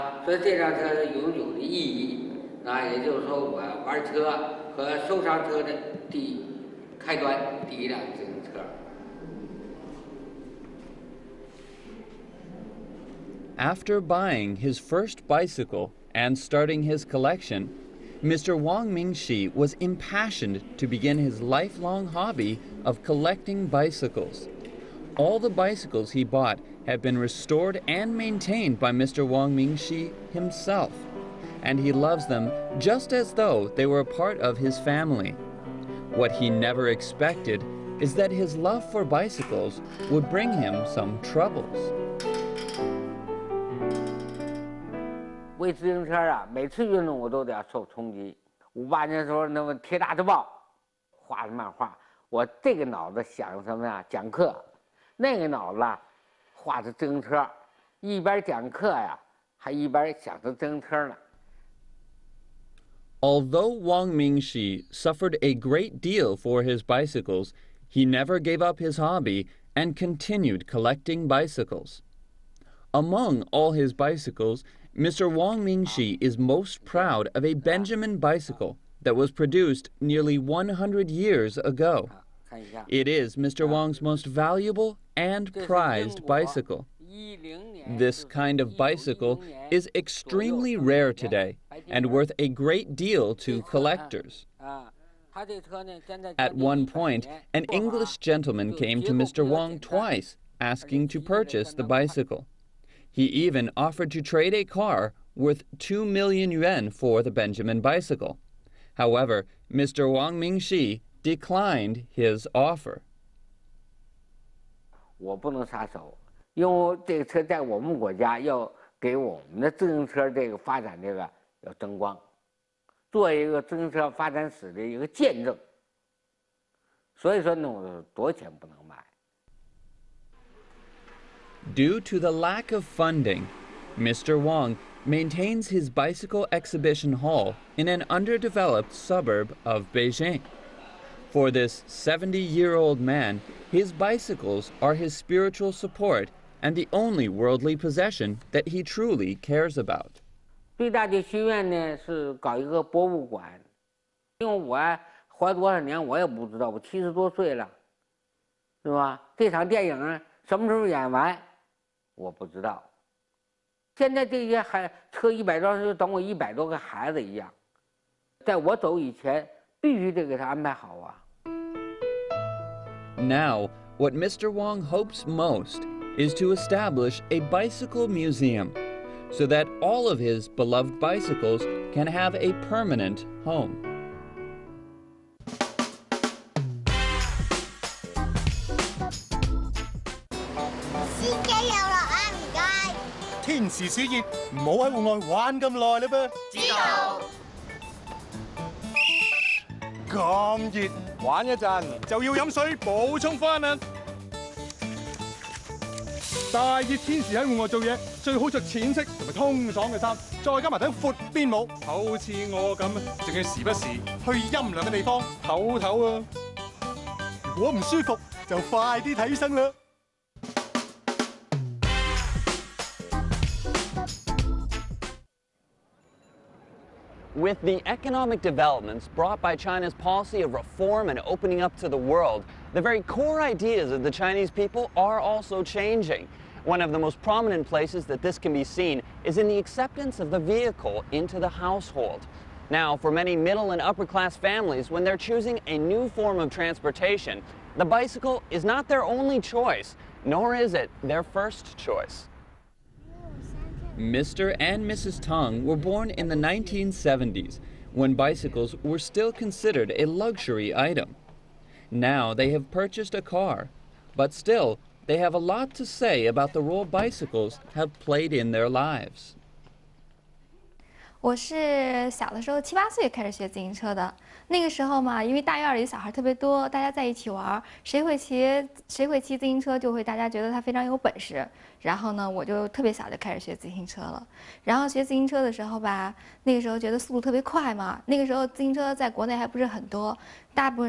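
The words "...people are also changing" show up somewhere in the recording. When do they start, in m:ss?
3:54.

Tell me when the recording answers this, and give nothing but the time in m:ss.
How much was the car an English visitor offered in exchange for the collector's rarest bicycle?
1:45.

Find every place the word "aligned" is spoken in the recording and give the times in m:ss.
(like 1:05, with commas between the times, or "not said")
not said.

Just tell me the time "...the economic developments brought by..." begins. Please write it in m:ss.
3:47.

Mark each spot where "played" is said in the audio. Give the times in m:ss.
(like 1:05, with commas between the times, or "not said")
4:27.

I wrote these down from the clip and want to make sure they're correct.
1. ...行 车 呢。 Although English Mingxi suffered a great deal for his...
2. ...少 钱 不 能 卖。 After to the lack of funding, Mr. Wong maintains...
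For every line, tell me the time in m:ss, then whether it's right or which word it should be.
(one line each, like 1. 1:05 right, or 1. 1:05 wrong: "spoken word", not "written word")
1. 1:00 wrong: "Wang", not "English"
2. 2:08 wrong: "Due", not "After".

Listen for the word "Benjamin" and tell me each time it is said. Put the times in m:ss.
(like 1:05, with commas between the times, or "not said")
1:17, 1:47.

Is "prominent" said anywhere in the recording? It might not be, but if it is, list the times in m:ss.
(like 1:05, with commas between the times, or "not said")
3:57.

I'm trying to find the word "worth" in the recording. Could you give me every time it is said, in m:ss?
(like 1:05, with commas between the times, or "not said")
1:32, 1:45.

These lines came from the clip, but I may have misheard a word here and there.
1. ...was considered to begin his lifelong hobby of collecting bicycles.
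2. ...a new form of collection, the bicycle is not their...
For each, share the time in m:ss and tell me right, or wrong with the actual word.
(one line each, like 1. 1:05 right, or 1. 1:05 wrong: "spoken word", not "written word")
1. 0:19 wrong: "impassioned", not "considered"
2. 4:05 wrong: "transportation", not "collection".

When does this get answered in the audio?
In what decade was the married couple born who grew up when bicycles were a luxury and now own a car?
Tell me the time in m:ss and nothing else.
4:16.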